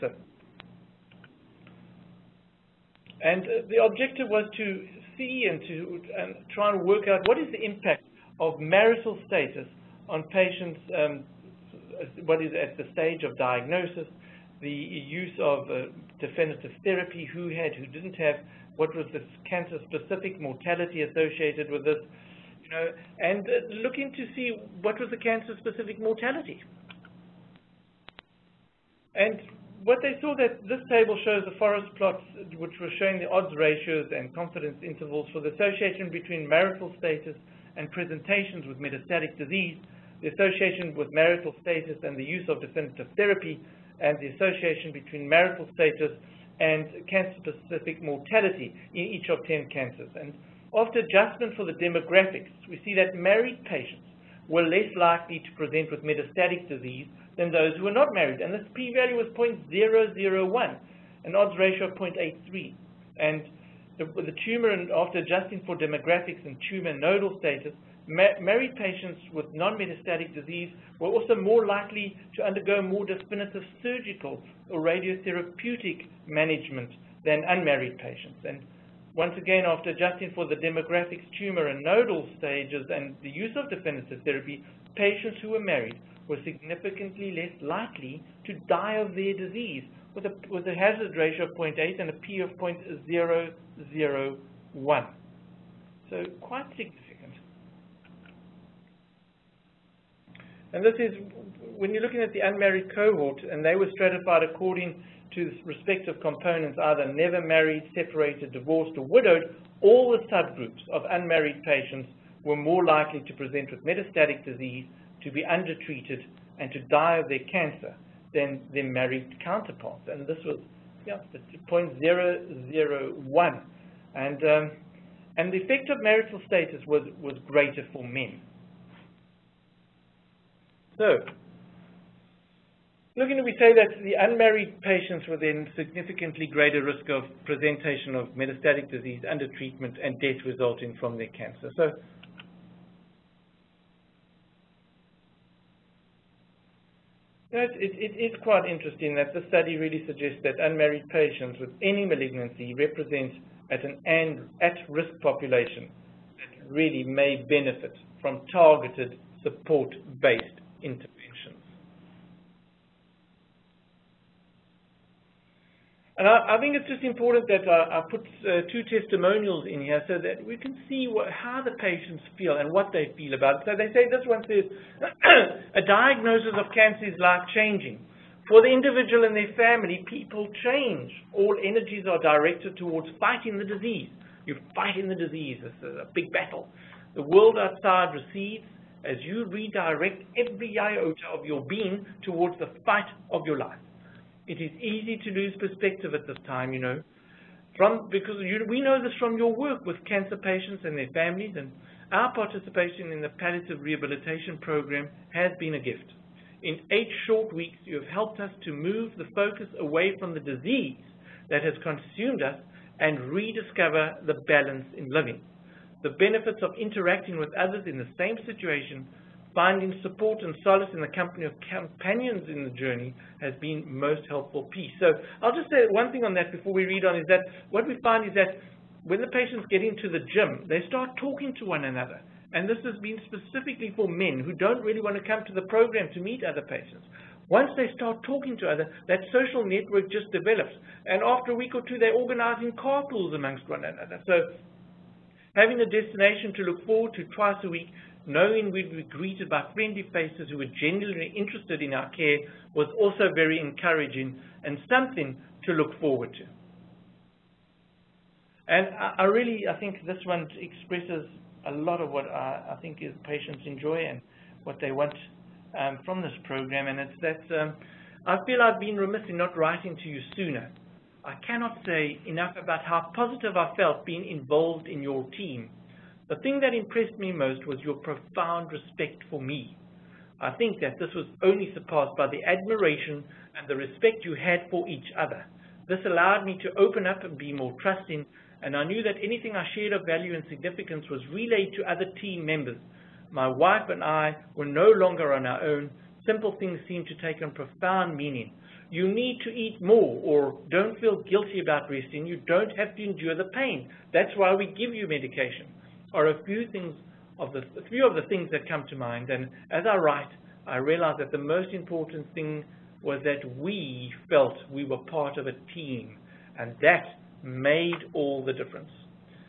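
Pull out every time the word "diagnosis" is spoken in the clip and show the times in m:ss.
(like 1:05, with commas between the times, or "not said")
0:13, 2:55.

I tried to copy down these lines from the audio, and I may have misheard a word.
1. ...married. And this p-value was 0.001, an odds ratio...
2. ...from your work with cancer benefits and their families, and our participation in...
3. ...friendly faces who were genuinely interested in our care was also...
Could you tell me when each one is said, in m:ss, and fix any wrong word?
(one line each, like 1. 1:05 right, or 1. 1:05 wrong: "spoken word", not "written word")
1. 0:58 right
2. 3:19 wrong: "patients", not "benefits"
3. 4:09 right.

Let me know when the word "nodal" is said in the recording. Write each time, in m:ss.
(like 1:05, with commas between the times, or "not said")
1:06, 1:21.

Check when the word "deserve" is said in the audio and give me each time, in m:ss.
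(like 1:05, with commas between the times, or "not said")
not said.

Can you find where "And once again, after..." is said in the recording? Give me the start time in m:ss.
1:18.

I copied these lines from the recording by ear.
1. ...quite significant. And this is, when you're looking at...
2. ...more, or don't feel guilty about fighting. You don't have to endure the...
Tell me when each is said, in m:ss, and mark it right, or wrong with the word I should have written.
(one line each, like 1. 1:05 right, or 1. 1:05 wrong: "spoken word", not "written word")
1. 1:36 right
2. 4:59 wrong: "resting", not "fighting".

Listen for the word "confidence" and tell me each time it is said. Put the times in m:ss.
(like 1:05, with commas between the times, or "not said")
0:34.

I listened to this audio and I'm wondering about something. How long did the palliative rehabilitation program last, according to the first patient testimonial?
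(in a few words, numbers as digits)
8 weeks.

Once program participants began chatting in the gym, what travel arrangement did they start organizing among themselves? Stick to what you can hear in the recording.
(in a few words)
Carpools.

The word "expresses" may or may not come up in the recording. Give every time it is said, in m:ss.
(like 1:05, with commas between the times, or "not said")
4:20.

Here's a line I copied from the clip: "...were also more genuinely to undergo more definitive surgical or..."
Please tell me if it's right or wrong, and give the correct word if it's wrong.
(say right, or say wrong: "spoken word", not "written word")
wrong: "likely", not "genuinely".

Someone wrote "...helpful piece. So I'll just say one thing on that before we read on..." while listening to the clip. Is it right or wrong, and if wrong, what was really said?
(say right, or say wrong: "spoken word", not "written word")
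right.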